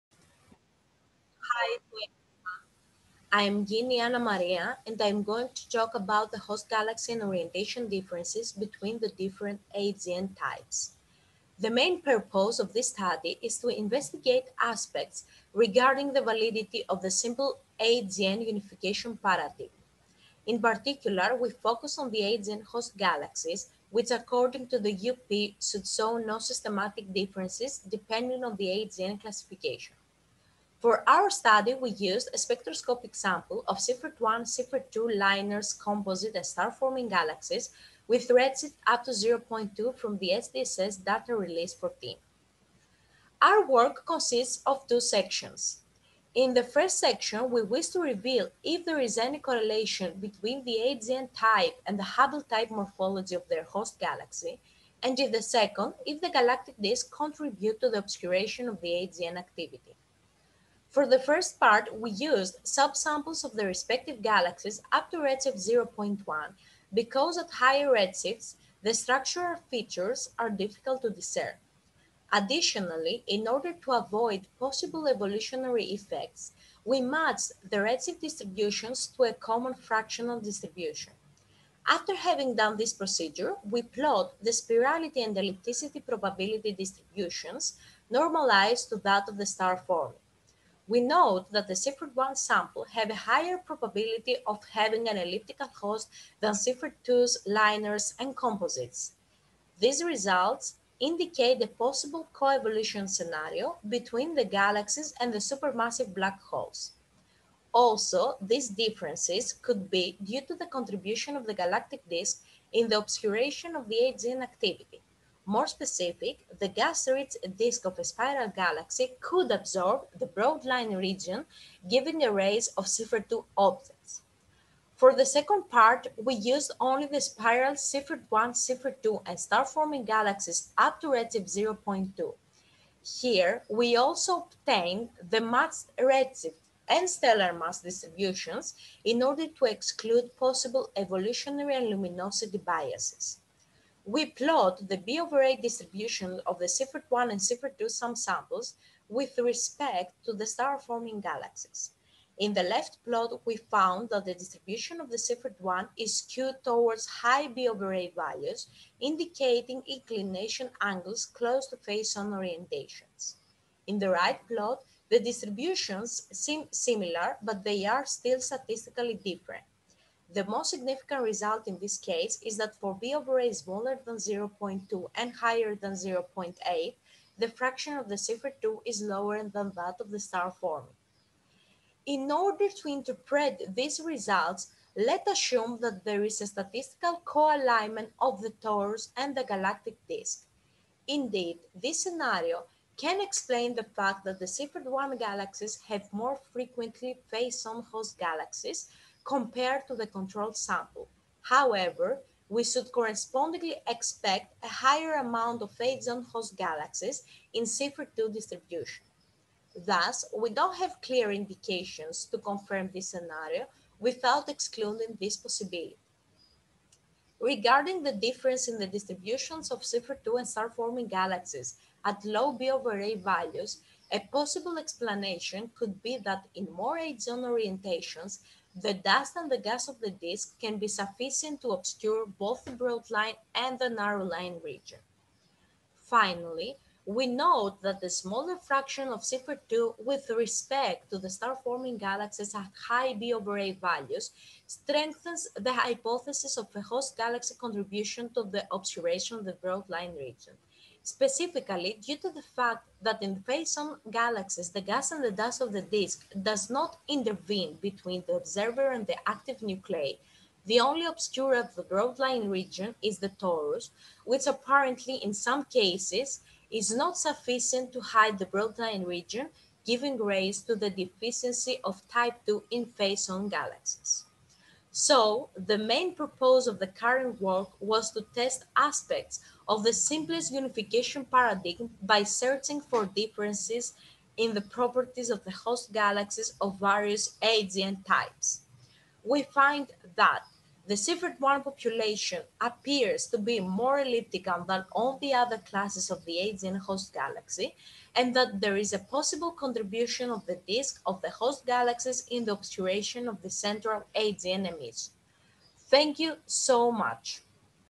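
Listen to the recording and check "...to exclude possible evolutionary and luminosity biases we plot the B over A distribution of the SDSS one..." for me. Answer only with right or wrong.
wrong.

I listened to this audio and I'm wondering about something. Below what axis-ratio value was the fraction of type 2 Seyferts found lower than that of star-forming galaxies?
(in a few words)
0.2.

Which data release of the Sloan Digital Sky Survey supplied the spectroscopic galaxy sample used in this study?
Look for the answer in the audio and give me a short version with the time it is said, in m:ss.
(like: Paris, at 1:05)
Data release 14, at 0:40.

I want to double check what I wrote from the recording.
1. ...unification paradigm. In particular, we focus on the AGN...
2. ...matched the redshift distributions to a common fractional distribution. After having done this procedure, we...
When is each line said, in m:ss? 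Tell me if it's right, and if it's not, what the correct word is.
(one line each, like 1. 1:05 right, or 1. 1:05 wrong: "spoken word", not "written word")
1. 0:18 right
2. 1:16 right.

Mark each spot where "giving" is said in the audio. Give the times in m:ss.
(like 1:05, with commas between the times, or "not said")
2:01, 4:29.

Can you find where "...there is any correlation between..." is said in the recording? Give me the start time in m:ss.
0:48.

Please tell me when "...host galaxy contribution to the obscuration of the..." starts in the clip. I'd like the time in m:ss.
4:06.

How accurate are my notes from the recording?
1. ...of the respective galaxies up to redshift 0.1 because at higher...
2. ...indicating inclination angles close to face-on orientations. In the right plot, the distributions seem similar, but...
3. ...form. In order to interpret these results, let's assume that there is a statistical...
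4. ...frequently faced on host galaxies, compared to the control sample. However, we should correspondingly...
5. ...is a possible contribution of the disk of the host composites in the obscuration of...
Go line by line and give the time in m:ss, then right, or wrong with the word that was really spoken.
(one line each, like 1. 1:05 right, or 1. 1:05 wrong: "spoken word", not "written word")
1. 1:03 right
2. 2:38 right
3. 3:00 right
4. 3:16 right
5. 4:58 wrong: "galaxies", not "composites".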